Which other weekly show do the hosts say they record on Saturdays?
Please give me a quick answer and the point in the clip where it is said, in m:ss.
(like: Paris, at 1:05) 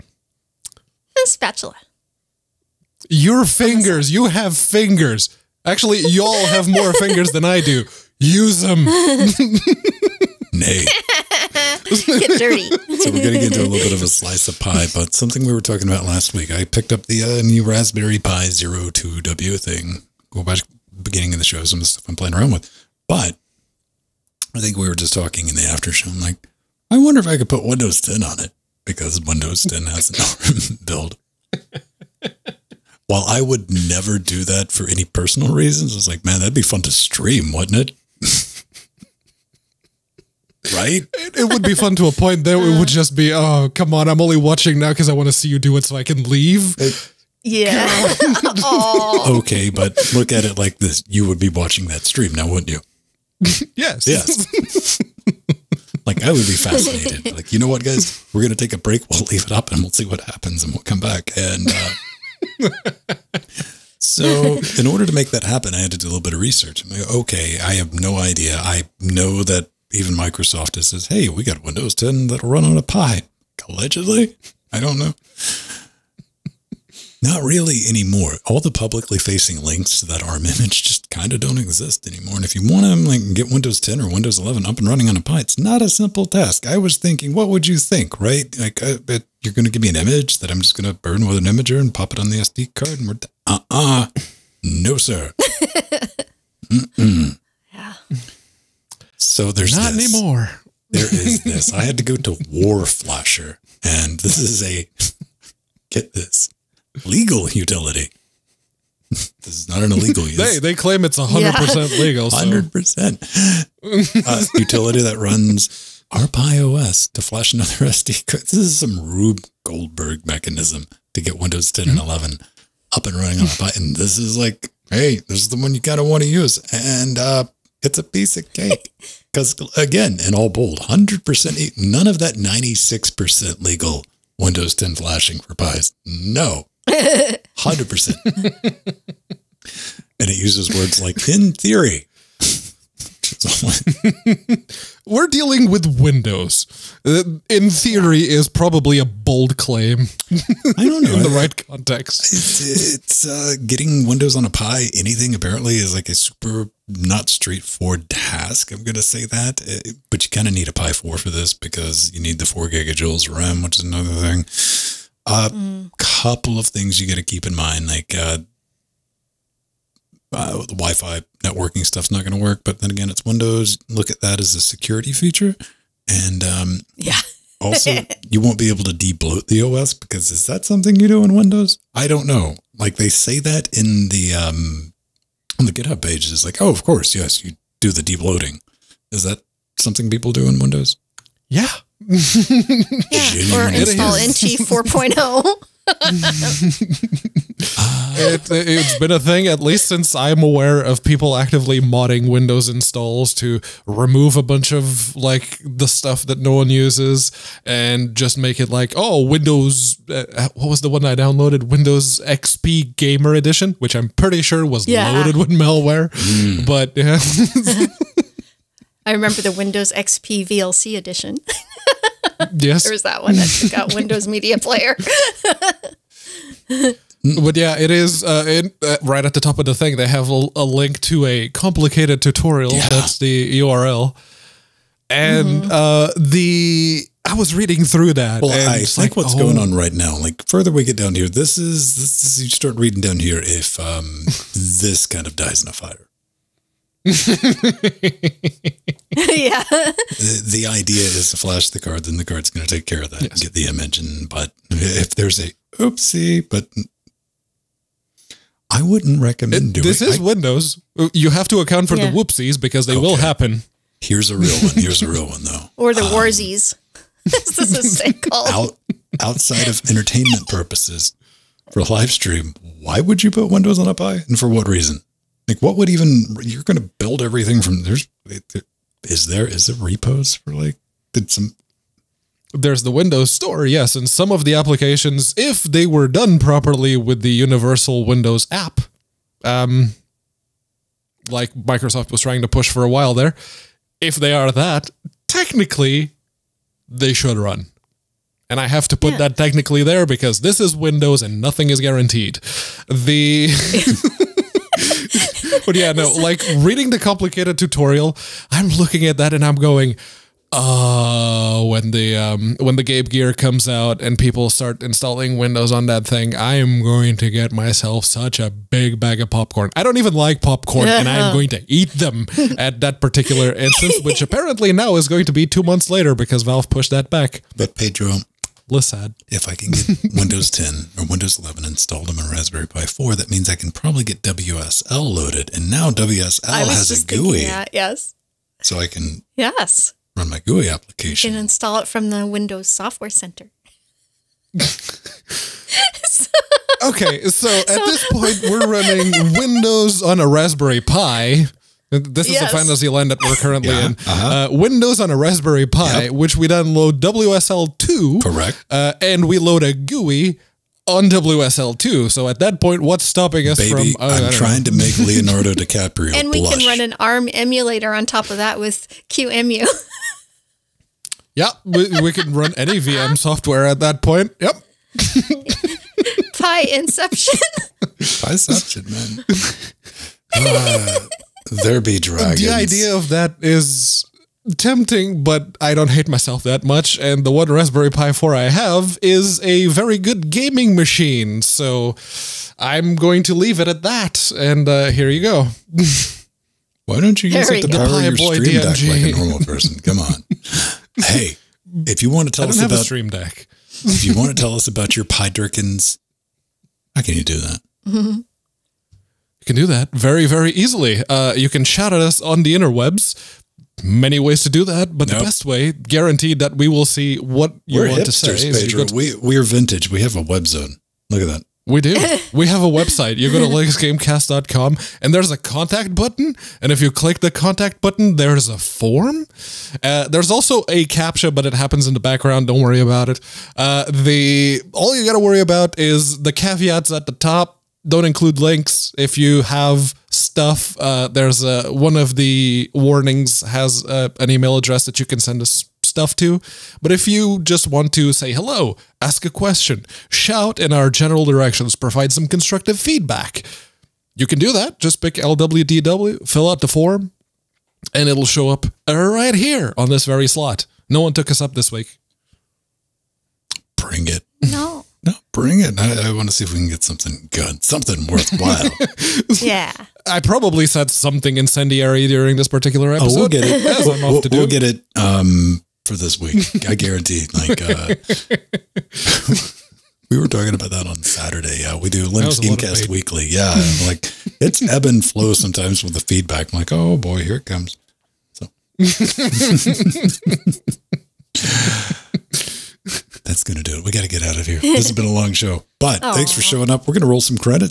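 Linux Gamecast weekly, at 8:02.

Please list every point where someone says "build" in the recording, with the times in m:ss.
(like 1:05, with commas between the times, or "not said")
0:30, 4:36.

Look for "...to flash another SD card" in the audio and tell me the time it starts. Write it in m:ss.
1:57.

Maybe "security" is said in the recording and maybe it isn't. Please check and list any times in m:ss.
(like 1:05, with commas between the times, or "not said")
2:54.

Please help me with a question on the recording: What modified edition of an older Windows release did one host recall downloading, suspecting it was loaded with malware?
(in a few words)
Windows XP Gamer Edition.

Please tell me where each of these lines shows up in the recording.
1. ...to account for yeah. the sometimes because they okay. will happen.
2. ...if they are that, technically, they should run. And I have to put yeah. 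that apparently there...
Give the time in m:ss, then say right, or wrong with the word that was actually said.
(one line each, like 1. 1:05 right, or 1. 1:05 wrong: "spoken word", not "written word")
1. 4:21 wrong: "whoopsies", not "sometimes"
2. 4:53 wrong: "technically", not "apparently".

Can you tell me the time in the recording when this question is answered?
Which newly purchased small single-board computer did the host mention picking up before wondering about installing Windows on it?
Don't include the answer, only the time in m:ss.
0:17.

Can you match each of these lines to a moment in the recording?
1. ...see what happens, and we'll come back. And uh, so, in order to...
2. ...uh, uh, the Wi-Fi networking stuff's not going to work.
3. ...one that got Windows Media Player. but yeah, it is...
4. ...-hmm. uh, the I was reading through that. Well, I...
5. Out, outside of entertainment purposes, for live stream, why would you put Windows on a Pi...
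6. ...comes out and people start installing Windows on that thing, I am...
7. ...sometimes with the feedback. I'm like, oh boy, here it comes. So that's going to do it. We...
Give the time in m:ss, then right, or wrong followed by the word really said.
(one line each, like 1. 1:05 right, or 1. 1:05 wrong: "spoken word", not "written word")
1. 0:59 right
2. 2:48 right
3. 3:43 right
4. 3:55 right
5. 4:28 right
6. 5:13 right
7. 8:05 right.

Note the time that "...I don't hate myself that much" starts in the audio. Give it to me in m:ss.
6:25.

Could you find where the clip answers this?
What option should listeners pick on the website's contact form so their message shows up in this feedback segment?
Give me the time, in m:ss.
7:35.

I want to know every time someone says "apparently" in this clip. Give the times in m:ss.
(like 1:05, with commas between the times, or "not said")
2:35, 5:24.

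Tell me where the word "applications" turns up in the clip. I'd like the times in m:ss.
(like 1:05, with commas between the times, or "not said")
4:44, 5:40.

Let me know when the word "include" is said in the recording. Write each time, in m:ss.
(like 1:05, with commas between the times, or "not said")
7:18.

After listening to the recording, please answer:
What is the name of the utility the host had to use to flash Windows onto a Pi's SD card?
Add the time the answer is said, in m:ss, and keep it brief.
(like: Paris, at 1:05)
WoR Flasher, at 1:42.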